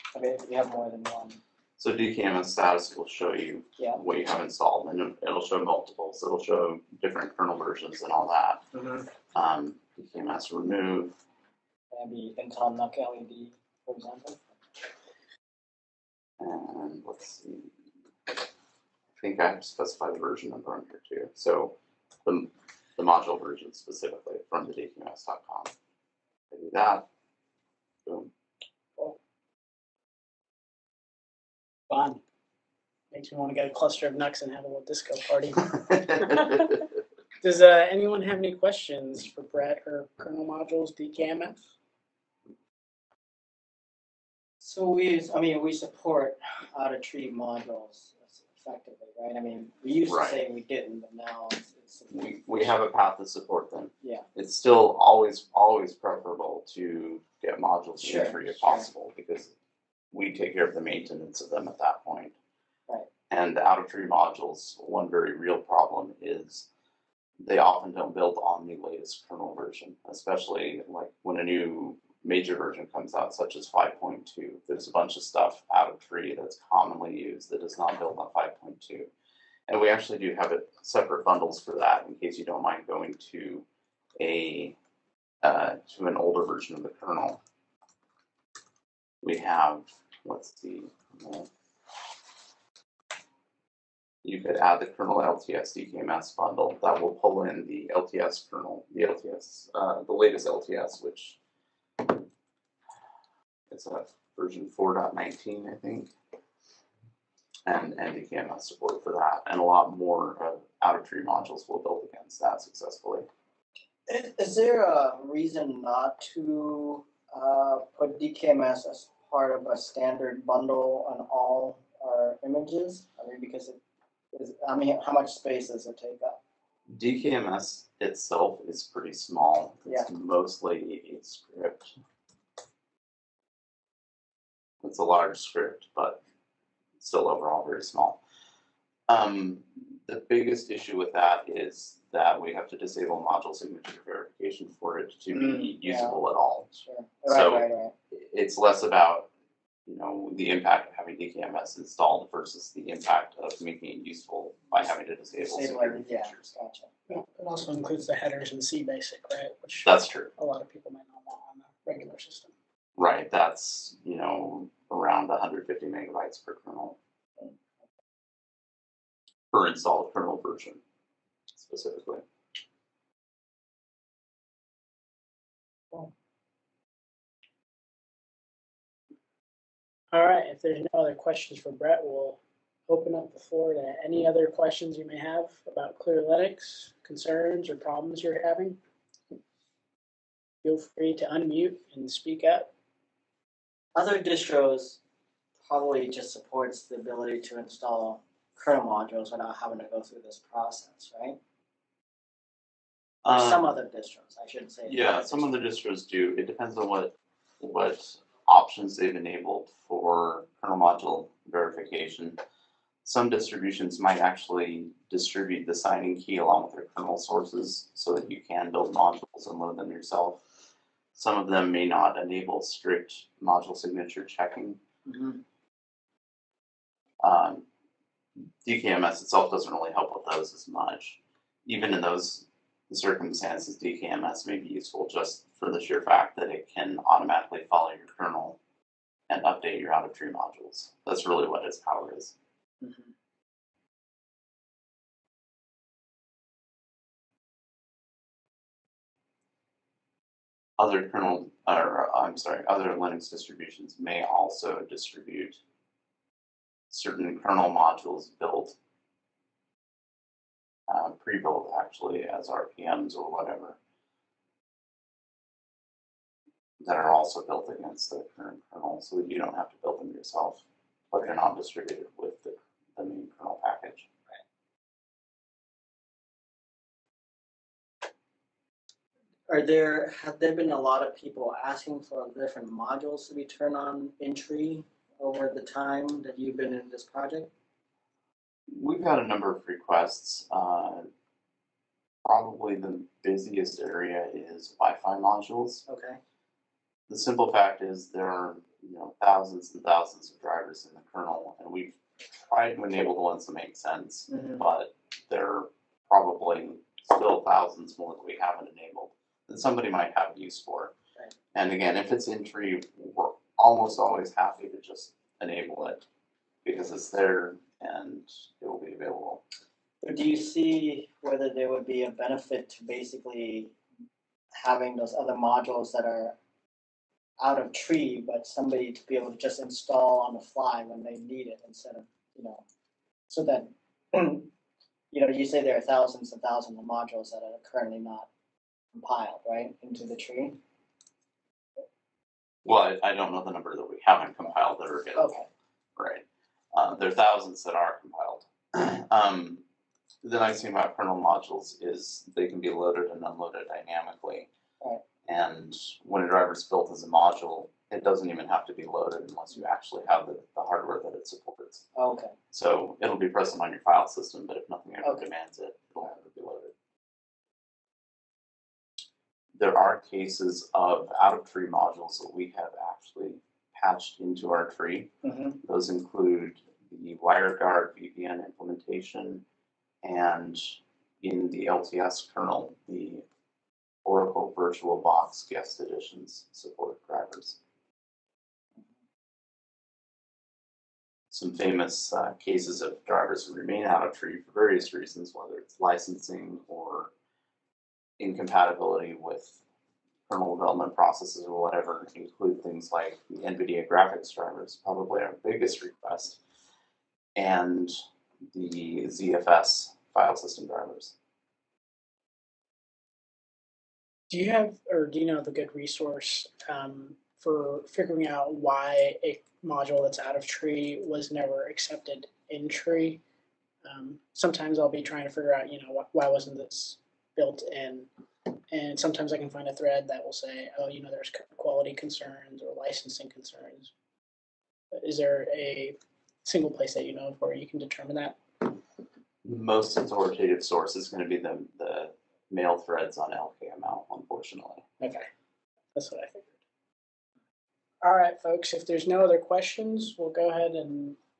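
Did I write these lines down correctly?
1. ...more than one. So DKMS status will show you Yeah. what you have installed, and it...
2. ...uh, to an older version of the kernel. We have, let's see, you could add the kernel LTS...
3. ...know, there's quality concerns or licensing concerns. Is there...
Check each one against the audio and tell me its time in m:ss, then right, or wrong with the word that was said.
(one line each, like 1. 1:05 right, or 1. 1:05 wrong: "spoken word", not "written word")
1. 0:00 right
2. 1:25 right
3. 7:11 right.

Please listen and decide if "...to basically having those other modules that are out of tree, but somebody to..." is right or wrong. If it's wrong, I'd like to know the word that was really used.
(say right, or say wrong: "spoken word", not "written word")
right.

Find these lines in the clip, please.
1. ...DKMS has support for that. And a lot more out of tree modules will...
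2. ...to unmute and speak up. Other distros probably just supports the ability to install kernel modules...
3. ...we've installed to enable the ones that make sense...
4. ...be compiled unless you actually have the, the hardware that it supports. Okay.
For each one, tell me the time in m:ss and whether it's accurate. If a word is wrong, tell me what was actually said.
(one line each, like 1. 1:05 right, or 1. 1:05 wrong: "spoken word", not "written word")
1. 1:48 right
2. 3:11 right
3. 5:01 wrong: "tried", not "installed"
4. 5:58 wrong: "loaded", not "compiled".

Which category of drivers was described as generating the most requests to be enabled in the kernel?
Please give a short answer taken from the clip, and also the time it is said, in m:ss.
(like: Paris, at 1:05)
Wi-Fi modules, at 4:54.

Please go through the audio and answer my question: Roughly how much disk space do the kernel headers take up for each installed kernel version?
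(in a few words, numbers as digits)
150 megabytes.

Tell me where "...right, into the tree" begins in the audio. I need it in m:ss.
5:39.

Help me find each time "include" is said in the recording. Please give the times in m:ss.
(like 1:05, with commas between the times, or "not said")
2:37, 6:15, 6:42.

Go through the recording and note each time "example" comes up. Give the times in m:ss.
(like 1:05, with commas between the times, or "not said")
0:13.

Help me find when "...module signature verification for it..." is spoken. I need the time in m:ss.
2:23.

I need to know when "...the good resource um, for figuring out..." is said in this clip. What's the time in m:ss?
6:55.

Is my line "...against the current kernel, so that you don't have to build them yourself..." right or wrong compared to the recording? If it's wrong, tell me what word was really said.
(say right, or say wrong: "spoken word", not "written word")
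right.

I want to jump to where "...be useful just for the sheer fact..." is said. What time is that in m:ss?
3:54.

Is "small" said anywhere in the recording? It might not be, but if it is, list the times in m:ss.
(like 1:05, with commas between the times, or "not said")
2:09, 2:17.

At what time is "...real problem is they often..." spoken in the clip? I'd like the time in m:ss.
1:05.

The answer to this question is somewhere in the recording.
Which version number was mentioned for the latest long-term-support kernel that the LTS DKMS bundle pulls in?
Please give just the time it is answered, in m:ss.
1:44.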